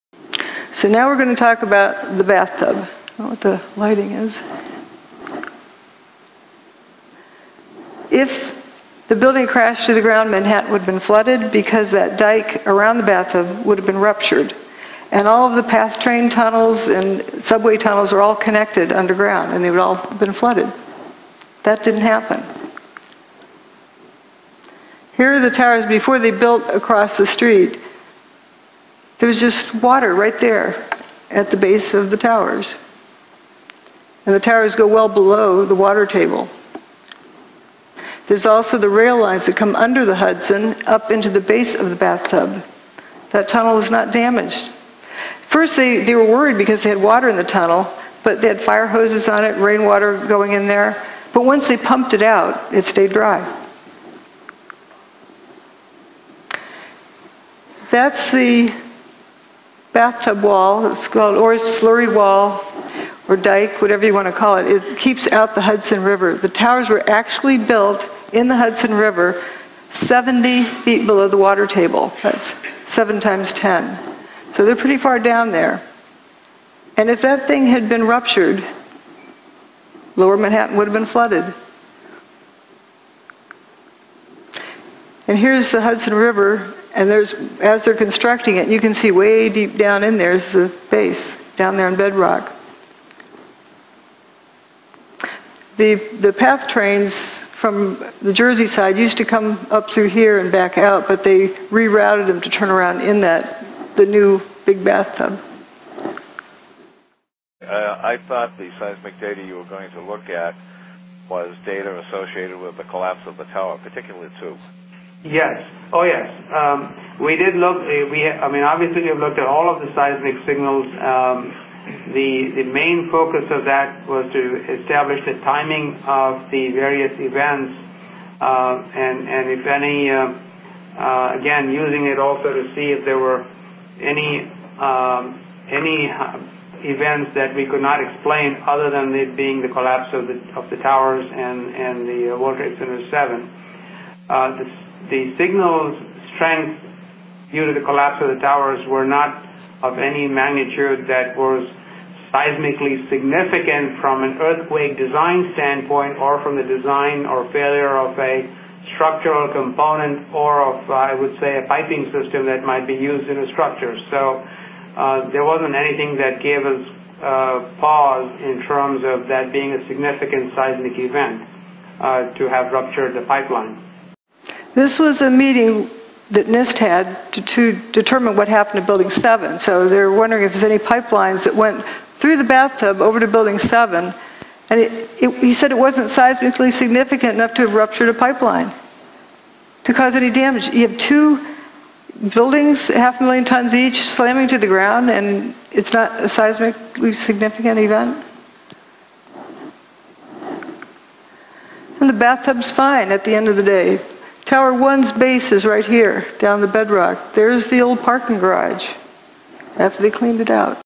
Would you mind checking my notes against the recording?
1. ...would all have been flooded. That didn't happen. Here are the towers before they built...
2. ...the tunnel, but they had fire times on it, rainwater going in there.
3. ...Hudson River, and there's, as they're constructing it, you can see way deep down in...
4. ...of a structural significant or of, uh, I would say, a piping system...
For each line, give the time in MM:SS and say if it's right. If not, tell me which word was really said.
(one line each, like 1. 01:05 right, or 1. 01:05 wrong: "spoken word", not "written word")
1. 00:19 right
2. 00:47 wrong: "hoses", not "times"
3. 01:25 right
4. 02:37 wrong: "component", not "significant".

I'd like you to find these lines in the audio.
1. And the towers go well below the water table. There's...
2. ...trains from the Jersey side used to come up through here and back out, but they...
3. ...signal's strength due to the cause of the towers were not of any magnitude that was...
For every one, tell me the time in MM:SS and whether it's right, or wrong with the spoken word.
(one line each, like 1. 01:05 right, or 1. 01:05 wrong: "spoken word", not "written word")
1. 00:34 right
2. 01:36 right
3. 02:25 wrong: "collapse", not "cause".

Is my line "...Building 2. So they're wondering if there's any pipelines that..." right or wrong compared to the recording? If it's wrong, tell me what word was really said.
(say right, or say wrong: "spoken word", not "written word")
wrong: "7", not "2".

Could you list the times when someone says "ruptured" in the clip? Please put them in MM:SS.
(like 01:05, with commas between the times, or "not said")
00:13, 01:18, 02:52, 03:07.